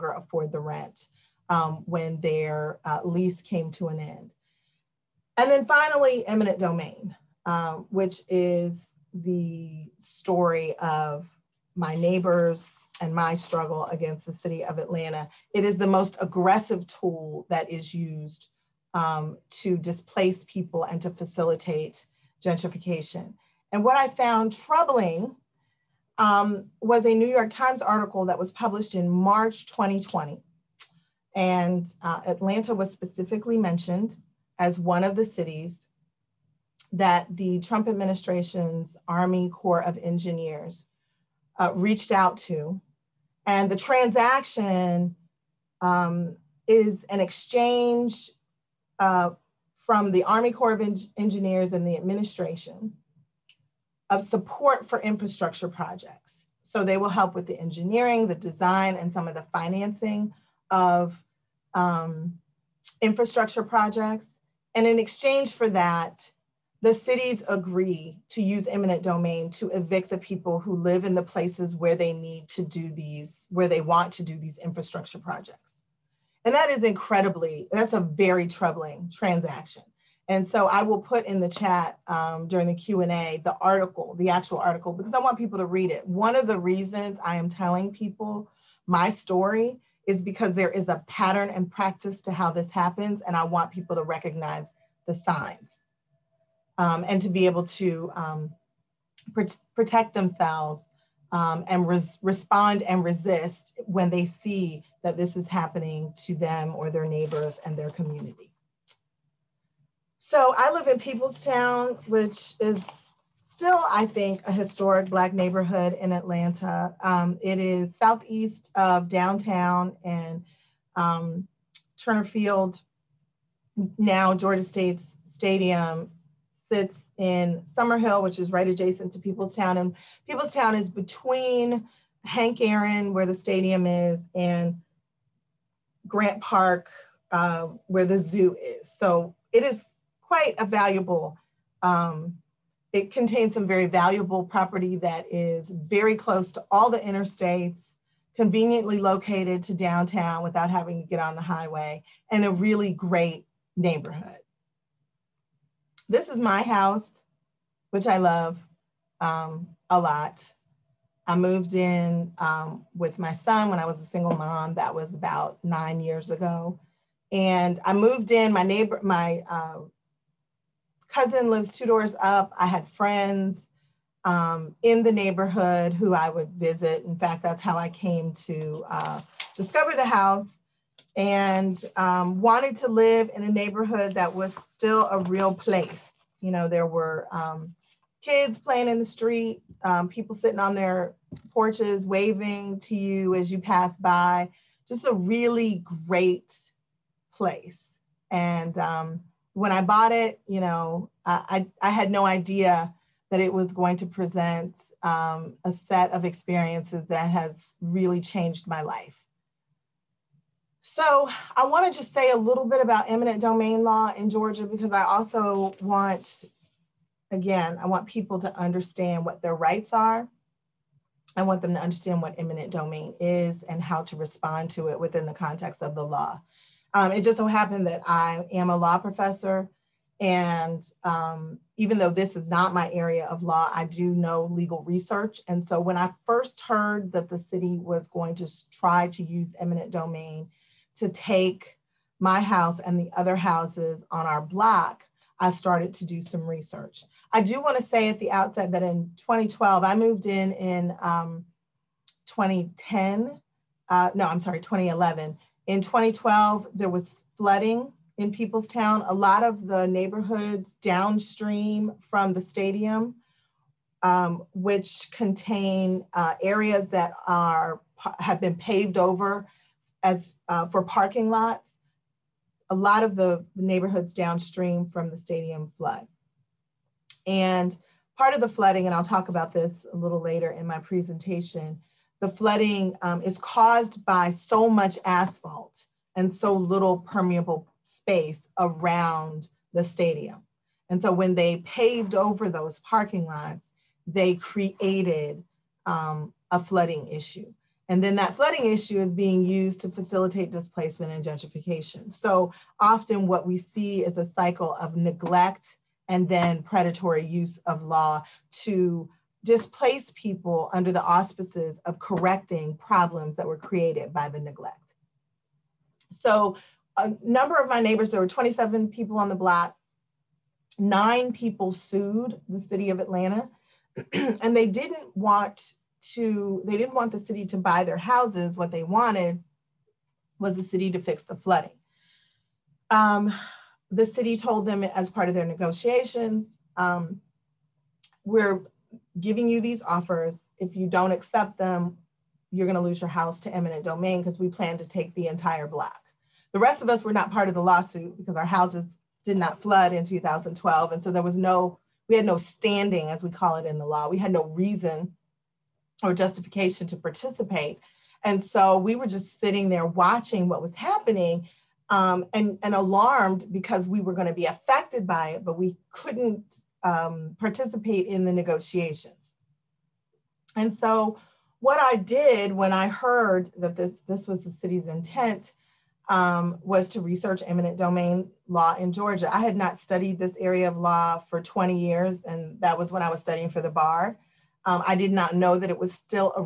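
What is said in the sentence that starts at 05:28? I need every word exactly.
What they wanted was the city to fix the flooding.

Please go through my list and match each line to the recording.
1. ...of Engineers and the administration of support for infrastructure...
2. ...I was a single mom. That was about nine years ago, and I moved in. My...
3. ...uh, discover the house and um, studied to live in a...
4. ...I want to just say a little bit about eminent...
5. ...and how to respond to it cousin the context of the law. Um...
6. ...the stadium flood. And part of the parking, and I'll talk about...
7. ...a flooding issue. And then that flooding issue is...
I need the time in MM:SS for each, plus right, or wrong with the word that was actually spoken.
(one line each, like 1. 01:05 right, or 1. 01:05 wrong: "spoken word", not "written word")
1. 00:50 right
2. 02:43 right
3. 02:58 wrong: "wanted", not "studied"
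4. 03:31 right
5. 03:43 wrong: "within", not "cousin"
6. 04:35 wrong: "flooding", not "parking"
7. 04:56 right.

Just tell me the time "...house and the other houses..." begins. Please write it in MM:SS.
04:02.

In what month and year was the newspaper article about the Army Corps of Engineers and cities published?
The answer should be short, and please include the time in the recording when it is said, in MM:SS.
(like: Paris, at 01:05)
March 2020, at 00:29.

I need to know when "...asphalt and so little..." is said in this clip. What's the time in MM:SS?
04:45.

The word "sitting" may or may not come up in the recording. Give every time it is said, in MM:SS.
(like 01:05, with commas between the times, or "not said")
03:10, 05:59.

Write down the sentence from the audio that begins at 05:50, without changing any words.
And so there was no, we had no standing, as we call it in the law.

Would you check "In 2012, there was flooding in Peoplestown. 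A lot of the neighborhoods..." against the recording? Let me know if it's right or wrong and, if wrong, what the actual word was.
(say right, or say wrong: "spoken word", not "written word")
right.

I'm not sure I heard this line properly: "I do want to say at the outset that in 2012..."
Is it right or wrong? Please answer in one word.
right.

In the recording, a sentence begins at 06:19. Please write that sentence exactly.
I had not studied this area of law for 20 years, and that was when I was studying for the bar.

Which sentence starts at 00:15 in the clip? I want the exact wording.
It is the most aggressive tool that is used um, to displace people and to facilitate gentrification.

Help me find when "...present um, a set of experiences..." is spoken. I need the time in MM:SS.
03:24.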